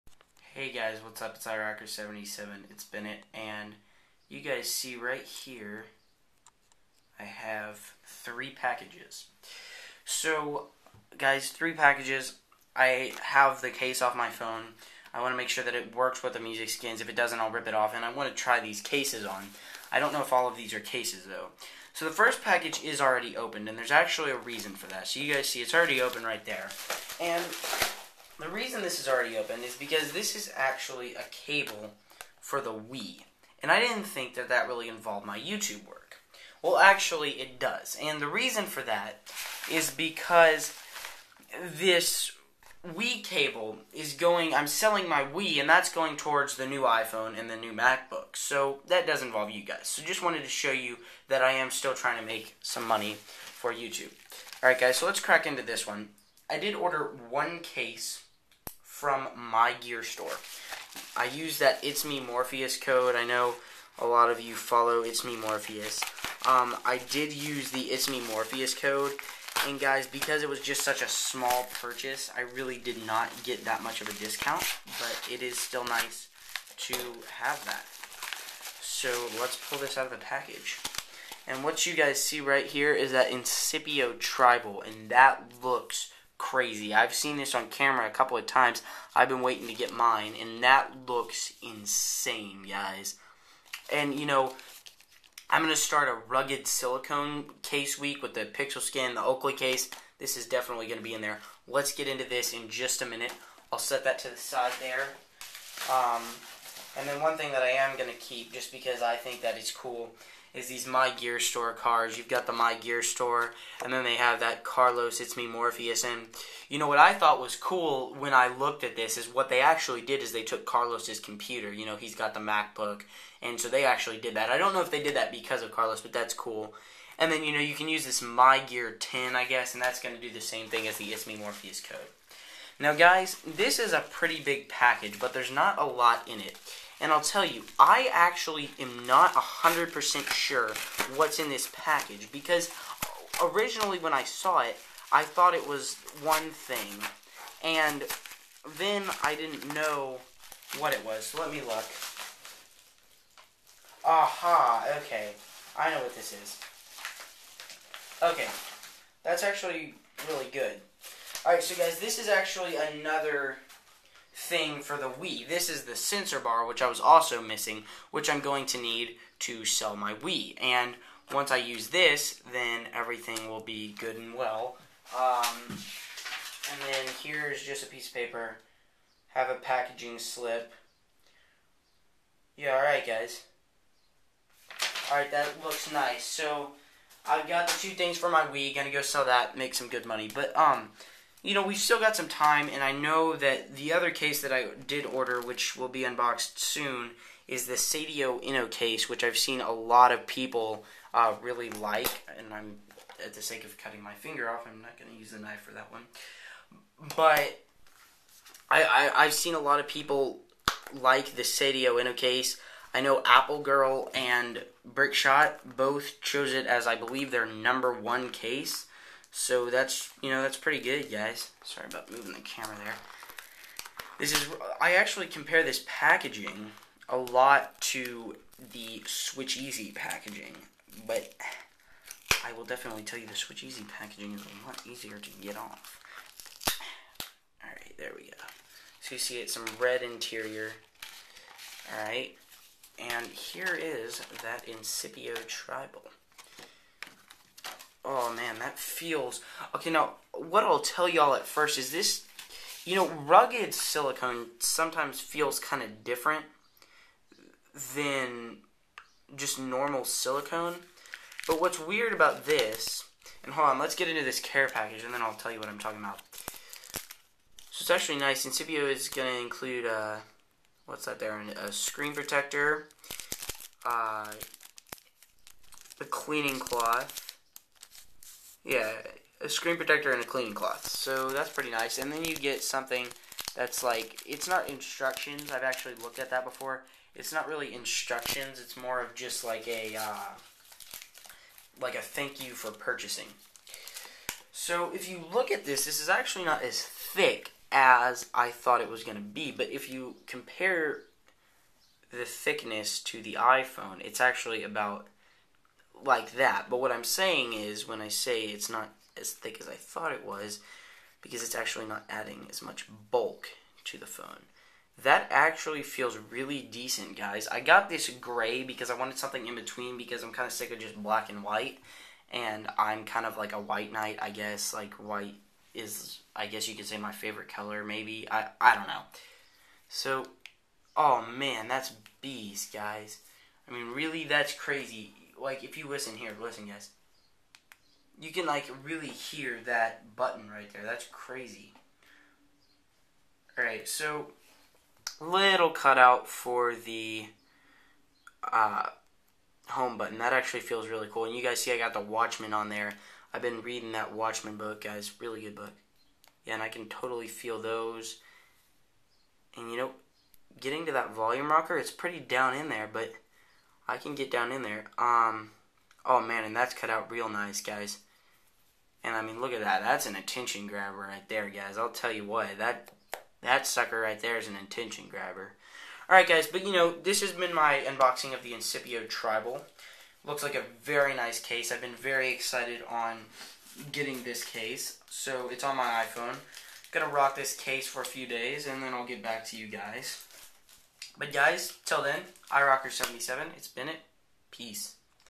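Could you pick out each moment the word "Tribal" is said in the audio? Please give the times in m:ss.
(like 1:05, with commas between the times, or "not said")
1:24, 4:05, 6:19.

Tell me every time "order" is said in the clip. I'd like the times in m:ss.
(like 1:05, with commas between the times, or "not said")
0:56, 3:15.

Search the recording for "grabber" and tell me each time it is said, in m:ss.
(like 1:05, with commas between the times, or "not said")
6:10, 6:15.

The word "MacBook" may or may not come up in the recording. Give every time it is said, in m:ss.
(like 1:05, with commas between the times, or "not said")
0:47, 2:02.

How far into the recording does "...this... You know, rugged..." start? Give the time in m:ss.
4:11.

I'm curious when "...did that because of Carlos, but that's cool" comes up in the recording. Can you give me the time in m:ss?
2:05.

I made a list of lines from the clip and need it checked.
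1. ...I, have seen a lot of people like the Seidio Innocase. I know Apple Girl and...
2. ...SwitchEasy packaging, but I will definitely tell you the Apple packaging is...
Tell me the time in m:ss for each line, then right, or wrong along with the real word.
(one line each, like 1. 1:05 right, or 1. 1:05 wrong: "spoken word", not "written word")
1. 3:29 right
2. 3:48 wrong: "SwitchEasy", not "Apple".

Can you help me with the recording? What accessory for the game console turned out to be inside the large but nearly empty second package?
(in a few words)
sensor bar.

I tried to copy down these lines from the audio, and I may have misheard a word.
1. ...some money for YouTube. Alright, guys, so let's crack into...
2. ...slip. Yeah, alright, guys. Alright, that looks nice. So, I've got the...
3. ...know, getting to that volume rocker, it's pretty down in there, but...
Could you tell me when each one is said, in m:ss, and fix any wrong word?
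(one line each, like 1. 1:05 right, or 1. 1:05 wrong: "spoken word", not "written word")
1. 0:52 right
2. 3:00 right
3. 5:59 right.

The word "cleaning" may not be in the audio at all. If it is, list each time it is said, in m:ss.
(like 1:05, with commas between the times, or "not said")
4:36, 4:40.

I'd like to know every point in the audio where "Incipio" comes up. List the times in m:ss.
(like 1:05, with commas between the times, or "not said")
1:23, 4:04, 4:28, 6:18.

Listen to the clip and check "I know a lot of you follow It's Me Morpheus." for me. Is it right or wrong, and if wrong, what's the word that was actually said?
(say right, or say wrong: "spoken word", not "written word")
right.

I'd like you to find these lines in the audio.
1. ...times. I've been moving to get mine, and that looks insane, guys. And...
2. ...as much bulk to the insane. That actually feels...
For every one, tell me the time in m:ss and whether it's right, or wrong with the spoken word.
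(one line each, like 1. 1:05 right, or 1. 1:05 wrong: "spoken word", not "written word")
1. 1:28 wrong: "waiting", not "moving"
2. 5:12 wrong: "phone", not "insane".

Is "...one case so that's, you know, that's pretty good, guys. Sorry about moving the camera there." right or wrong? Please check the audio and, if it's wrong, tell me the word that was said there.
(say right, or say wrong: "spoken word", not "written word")
right.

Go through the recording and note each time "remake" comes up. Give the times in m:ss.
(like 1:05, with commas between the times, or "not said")
not said.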